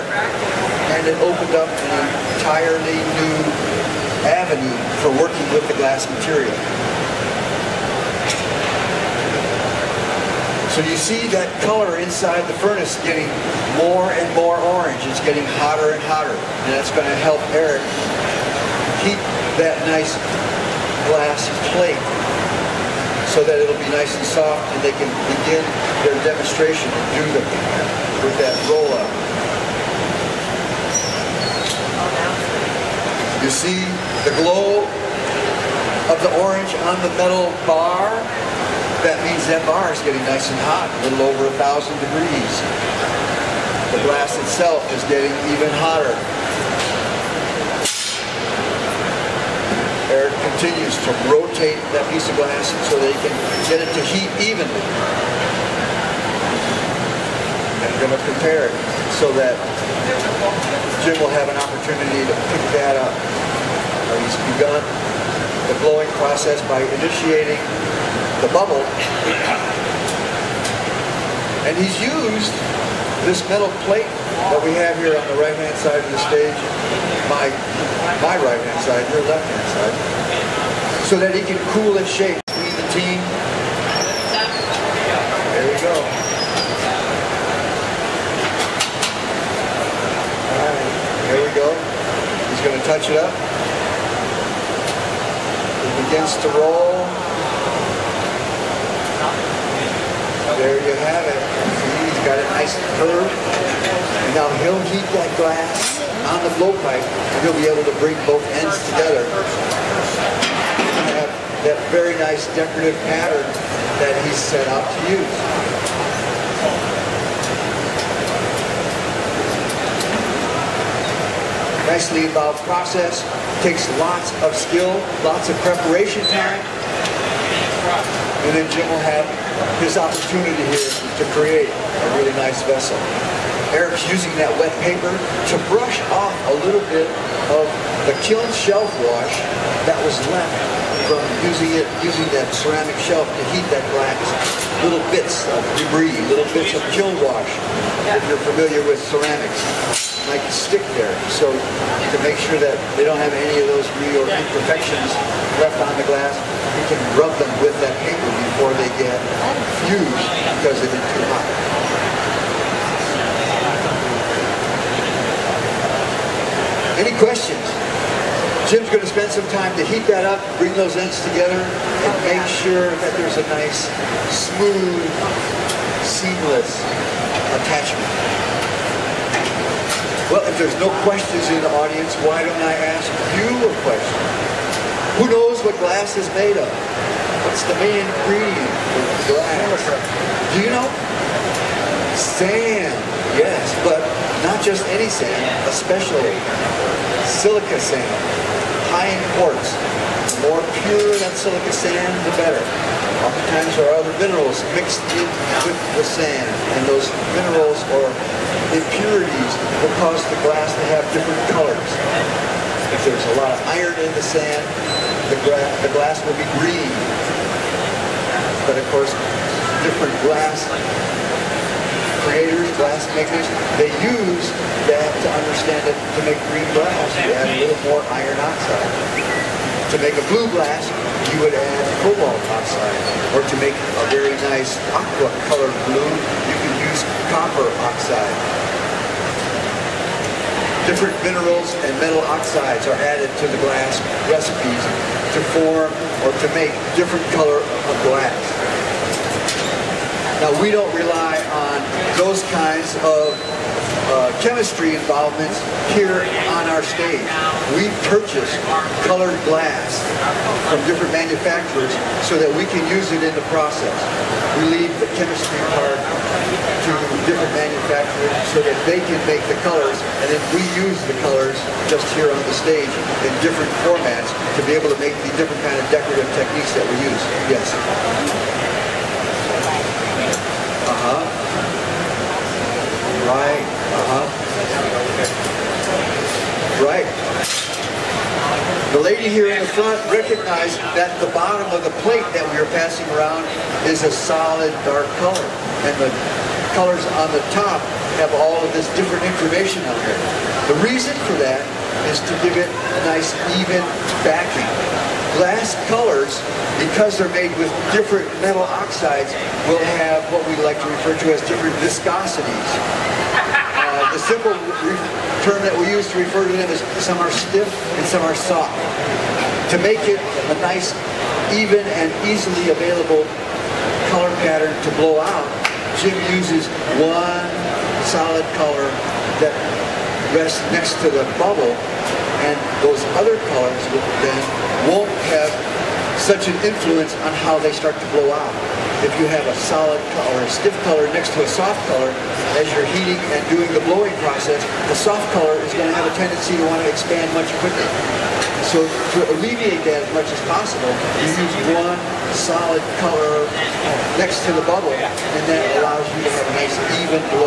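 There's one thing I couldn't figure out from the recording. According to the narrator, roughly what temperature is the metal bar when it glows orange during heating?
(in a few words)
a little over 1000 degrees.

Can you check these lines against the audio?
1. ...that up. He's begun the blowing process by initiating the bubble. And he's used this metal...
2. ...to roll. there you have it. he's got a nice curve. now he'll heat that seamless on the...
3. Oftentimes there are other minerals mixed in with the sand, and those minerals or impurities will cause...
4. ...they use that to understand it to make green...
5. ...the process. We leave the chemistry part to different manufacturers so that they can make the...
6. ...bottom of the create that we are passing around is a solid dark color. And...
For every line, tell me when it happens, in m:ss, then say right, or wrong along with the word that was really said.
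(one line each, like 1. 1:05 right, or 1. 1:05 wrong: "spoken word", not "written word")
1. 1:02 right
2. 1:36 wrong: "glass", not "seamless"
3. 3:23 right
4. 3:43 right
5. 4:23 right
6. 4:51 wrong: "plate", not "create".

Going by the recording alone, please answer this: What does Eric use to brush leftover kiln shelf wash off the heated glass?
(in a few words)
wet paper.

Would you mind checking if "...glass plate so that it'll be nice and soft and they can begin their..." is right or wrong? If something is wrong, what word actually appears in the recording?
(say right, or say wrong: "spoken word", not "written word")
right.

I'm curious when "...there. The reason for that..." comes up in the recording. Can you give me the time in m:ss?
5:00.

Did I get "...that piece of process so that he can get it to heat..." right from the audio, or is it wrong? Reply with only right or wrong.
wrong.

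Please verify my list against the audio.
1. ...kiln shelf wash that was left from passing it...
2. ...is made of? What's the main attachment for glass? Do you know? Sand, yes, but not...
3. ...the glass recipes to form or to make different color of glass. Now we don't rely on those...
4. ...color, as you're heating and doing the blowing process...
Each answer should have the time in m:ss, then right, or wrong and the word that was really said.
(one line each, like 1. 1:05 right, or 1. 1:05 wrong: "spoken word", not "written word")
1. 2:18 wrong: "using", not "passing"
2. 3:06 wrong: "ingredient", not "attachment"
3. 4:03 right
4. 5:41 right.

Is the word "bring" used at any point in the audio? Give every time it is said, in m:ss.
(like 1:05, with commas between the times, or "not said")
1:47, 2:50.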